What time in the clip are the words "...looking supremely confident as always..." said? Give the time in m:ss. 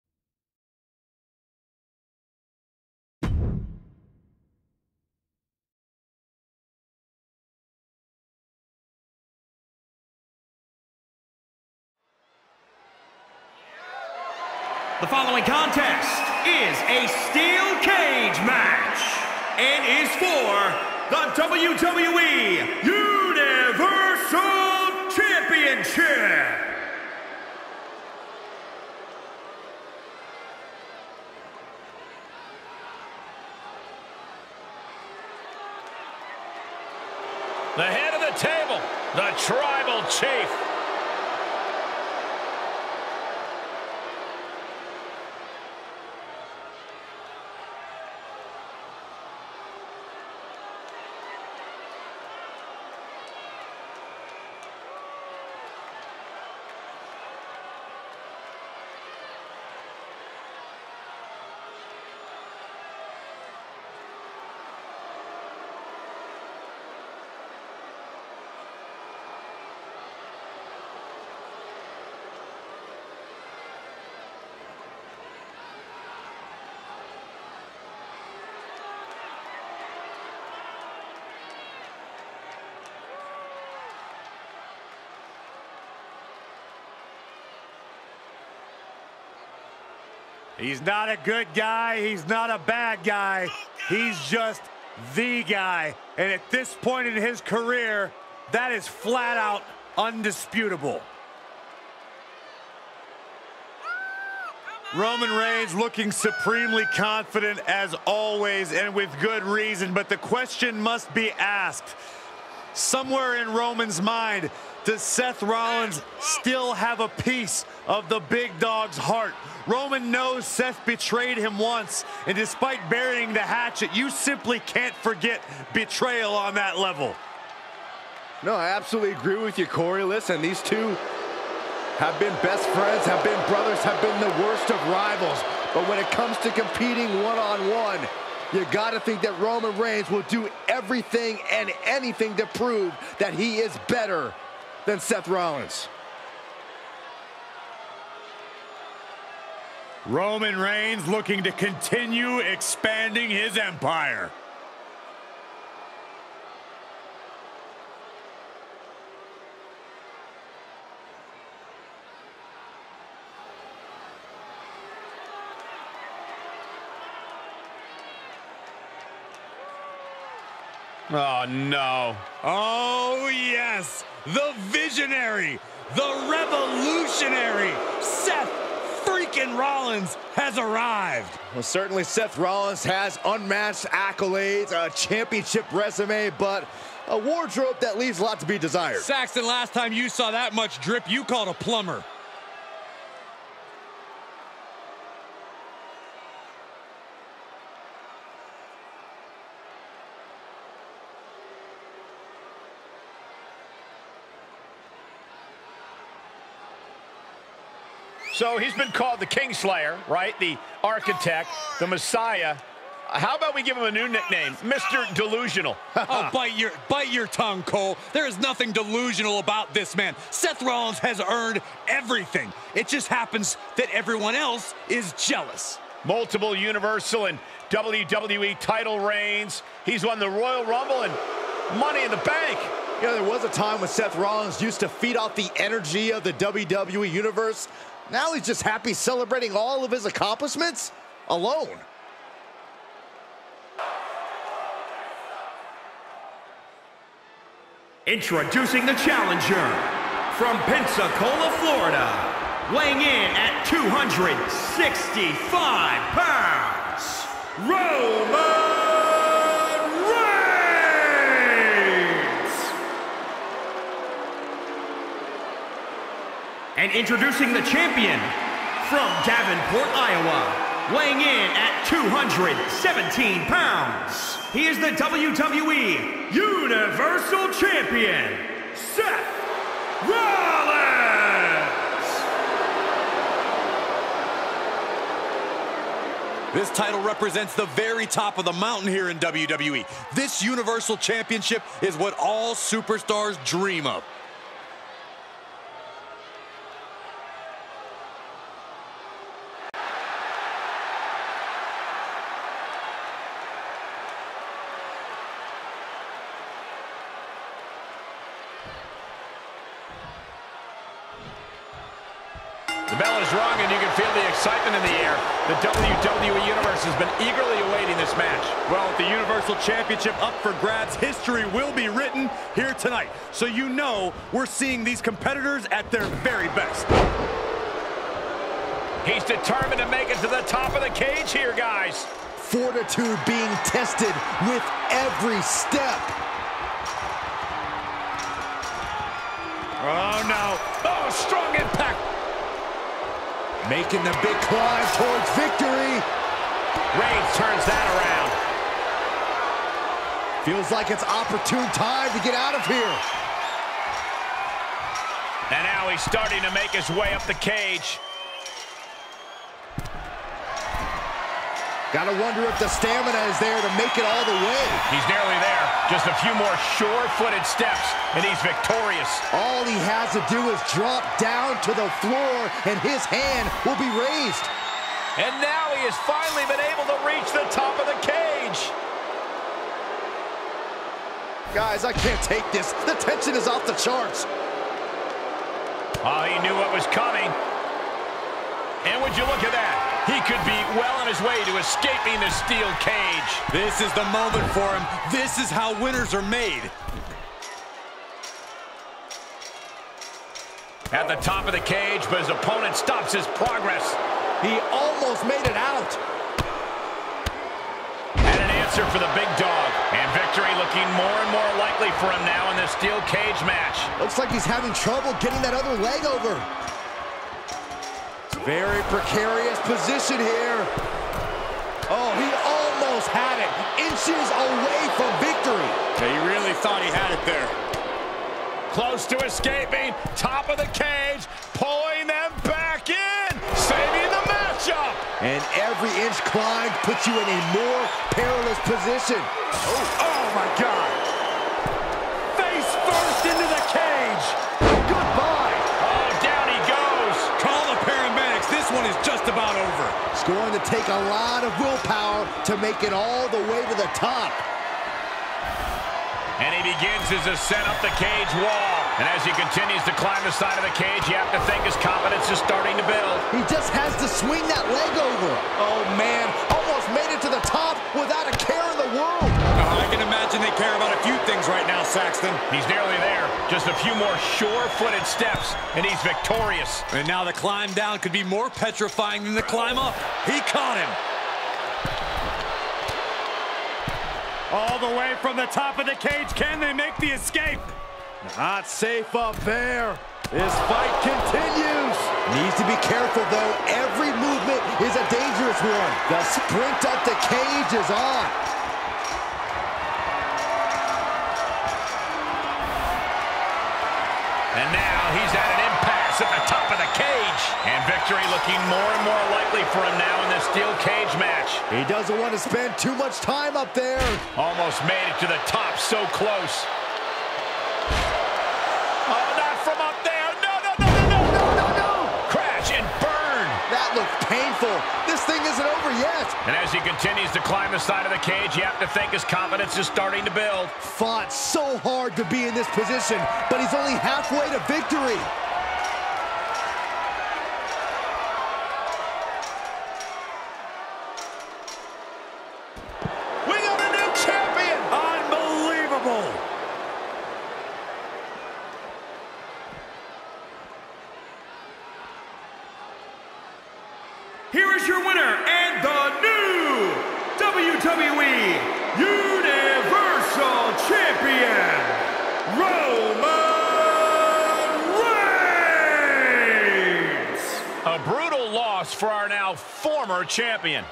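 1:45.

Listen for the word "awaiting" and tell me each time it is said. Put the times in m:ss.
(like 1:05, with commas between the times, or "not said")
5:17.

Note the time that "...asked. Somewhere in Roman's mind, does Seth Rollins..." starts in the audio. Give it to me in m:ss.
1:51.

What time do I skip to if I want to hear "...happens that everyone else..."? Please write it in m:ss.
3:43.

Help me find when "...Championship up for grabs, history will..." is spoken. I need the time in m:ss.
5:19.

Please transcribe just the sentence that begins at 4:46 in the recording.
This title represents the very top of the mountain here in WWE.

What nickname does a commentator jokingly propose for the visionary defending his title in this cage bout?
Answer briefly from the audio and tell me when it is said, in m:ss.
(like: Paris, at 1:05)
Mr. Delusional, at 3:34.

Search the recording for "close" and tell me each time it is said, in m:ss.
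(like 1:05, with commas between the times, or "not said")
7:08, 8:36.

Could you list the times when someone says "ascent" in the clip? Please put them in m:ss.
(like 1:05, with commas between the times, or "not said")
7:37.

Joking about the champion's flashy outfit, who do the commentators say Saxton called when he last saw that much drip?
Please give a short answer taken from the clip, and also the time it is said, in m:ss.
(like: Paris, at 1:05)
a plumber, at 3:11.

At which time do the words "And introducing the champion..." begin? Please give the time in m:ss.
4:26.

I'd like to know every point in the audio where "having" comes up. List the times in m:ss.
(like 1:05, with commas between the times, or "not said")
6:54.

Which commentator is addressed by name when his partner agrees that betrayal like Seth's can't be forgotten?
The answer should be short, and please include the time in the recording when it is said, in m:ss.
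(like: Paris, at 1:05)
Corey, at 2:09.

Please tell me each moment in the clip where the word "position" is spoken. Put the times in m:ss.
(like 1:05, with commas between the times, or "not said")
6:59, 7:18, 8:52.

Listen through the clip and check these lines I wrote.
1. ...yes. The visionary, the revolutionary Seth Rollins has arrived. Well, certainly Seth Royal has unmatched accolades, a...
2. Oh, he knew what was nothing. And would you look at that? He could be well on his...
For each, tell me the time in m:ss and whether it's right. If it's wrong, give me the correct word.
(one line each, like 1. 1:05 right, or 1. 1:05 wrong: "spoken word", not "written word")
1. 2:53 wrong: "Rollins", not "Royal"
2. 6:26 wrong: "coming", not "nothing".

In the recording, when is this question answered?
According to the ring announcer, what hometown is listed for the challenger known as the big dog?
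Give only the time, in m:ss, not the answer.
4:10.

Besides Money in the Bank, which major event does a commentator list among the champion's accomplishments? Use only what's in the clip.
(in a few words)
Royal Rumble.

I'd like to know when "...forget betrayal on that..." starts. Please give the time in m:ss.
2:04.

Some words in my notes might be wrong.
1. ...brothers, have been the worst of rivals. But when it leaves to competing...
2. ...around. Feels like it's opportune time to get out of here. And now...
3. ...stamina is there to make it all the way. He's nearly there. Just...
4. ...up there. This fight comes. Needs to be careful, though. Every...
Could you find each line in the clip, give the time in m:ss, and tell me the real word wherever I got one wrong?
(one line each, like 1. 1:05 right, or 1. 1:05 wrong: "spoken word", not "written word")
1. 2:13 wrong: "comes", not "leaves"
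2. 5:47 right
3. 6:02 right
4. 8:09 wrong: "continues", not "comes".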